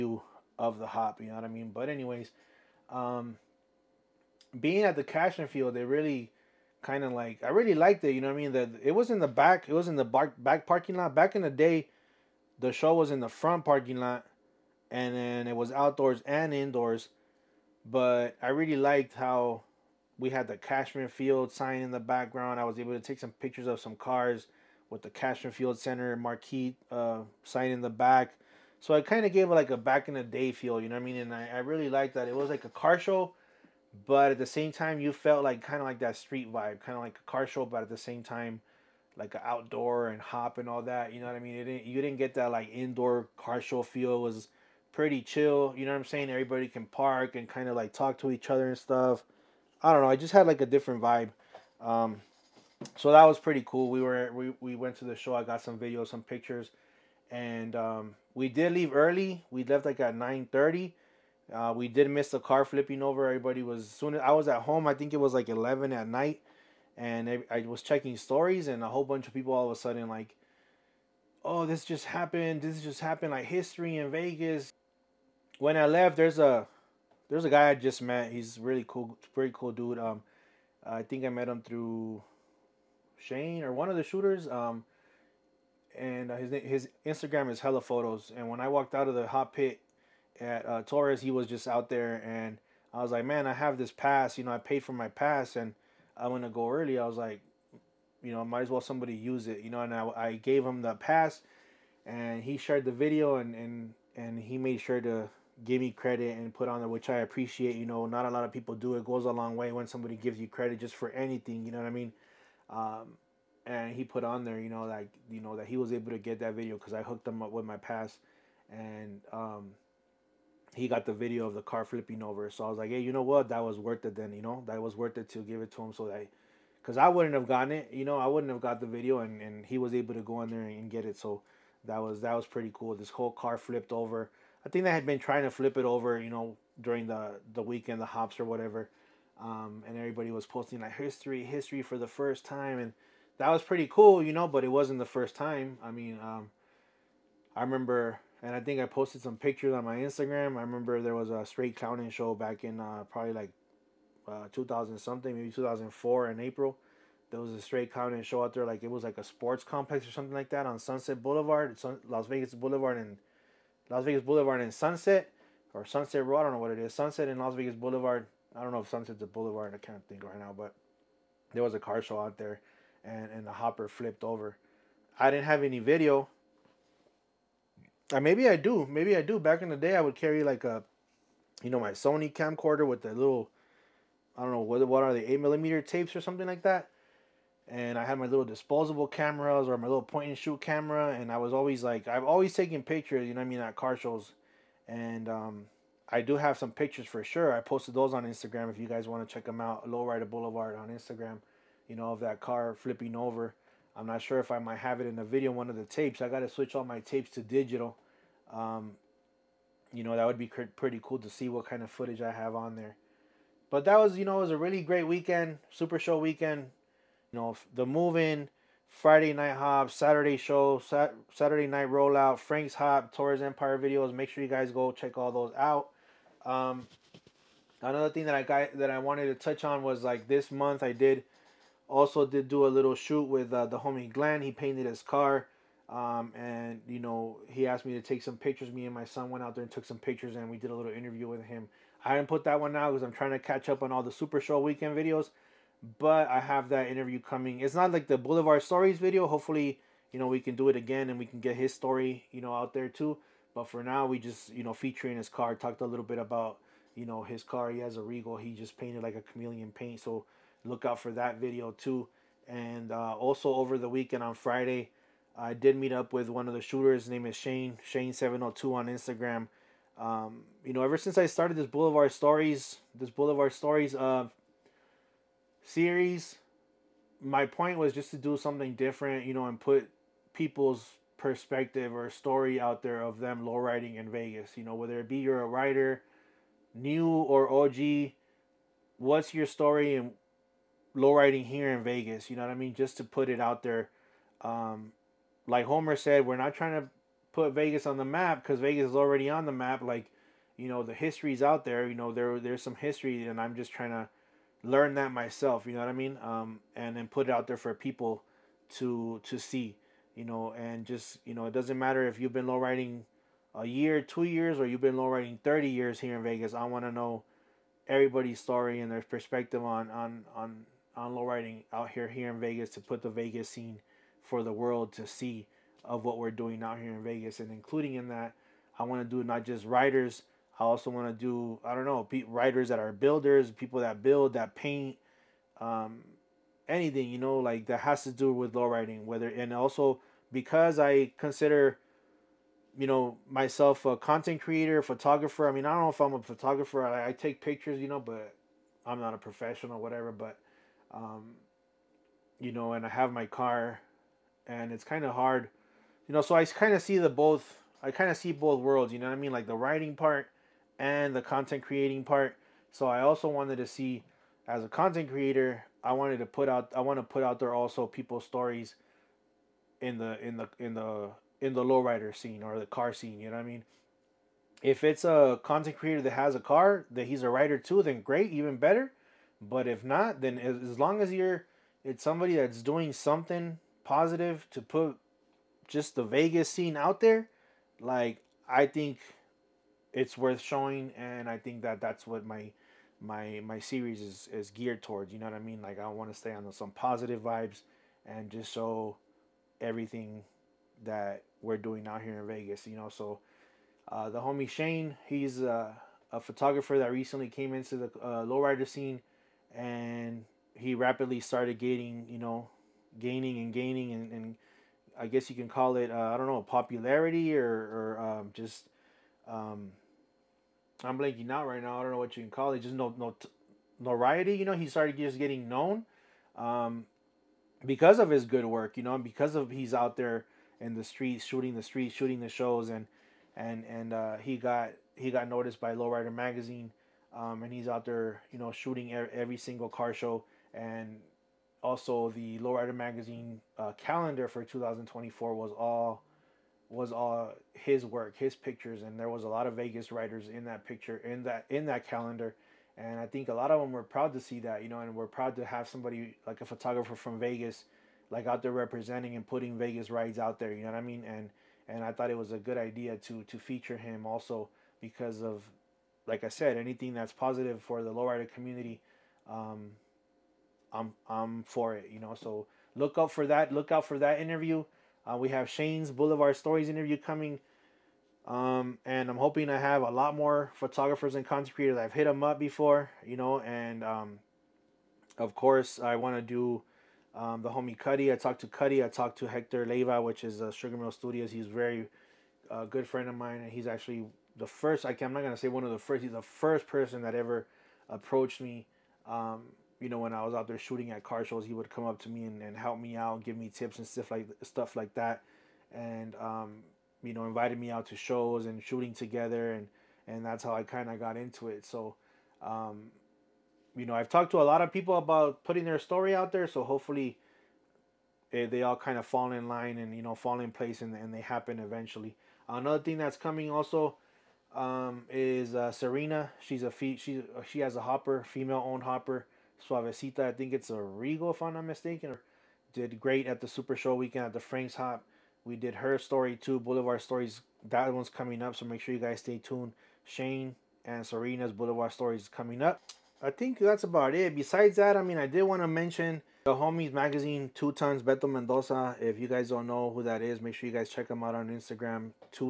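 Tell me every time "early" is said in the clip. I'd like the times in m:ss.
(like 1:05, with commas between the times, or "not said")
0:58, 1:36.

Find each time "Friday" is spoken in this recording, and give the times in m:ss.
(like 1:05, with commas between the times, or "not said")
3:38, 4:24.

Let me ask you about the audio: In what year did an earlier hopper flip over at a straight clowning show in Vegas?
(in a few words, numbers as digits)
2004.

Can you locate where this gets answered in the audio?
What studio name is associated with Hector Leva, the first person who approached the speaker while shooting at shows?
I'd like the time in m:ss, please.
8:10.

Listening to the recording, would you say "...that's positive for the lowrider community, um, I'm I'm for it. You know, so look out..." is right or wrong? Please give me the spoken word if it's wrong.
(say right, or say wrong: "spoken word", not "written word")
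right.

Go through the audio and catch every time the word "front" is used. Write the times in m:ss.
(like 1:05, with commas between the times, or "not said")
0:13.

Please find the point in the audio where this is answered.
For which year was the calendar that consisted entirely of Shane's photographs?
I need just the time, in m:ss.
7:24.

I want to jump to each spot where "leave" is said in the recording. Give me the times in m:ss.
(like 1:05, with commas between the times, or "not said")
0:58.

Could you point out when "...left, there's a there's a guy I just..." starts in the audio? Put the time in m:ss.
1:15.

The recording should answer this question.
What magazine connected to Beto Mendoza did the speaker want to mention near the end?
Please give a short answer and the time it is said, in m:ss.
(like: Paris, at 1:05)
Two Tons, at 9:07.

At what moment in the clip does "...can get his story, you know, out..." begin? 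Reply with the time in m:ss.
4:11.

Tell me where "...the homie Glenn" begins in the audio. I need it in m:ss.
3:53.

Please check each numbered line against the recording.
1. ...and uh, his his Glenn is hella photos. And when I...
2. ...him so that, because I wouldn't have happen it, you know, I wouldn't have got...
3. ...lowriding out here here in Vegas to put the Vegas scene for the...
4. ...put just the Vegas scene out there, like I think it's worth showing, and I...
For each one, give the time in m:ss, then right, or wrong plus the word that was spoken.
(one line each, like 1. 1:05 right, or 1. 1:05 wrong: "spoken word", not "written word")
1. 1:25 wrong: "Instagram", not "Glenn"
2. 2:05 wrong: "gotten", not "happen"
3. 5:21 right
4. 6:24 right.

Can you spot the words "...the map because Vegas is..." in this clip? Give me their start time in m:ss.
4:57.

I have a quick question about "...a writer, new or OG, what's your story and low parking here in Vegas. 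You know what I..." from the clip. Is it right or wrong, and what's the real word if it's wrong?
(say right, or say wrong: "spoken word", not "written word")
wrong: "riding", not "parking".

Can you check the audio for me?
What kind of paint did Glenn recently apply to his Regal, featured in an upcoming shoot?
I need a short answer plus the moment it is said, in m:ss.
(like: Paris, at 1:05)
chameleon paint, at 4:19.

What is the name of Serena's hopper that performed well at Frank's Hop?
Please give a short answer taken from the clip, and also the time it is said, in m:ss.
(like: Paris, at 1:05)
Suavecita, at 8:49.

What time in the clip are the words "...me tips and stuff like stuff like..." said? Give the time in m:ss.
8:23.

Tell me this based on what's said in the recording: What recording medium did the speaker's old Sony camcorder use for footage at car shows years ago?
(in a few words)
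8 millimeter tapes.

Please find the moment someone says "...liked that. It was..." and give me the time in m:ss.
0:31.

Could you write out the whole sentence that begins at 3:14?
And um, I do have some pictures for sure.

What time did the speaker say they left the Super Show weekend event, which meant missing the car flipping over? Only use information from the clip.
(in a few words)
9:30.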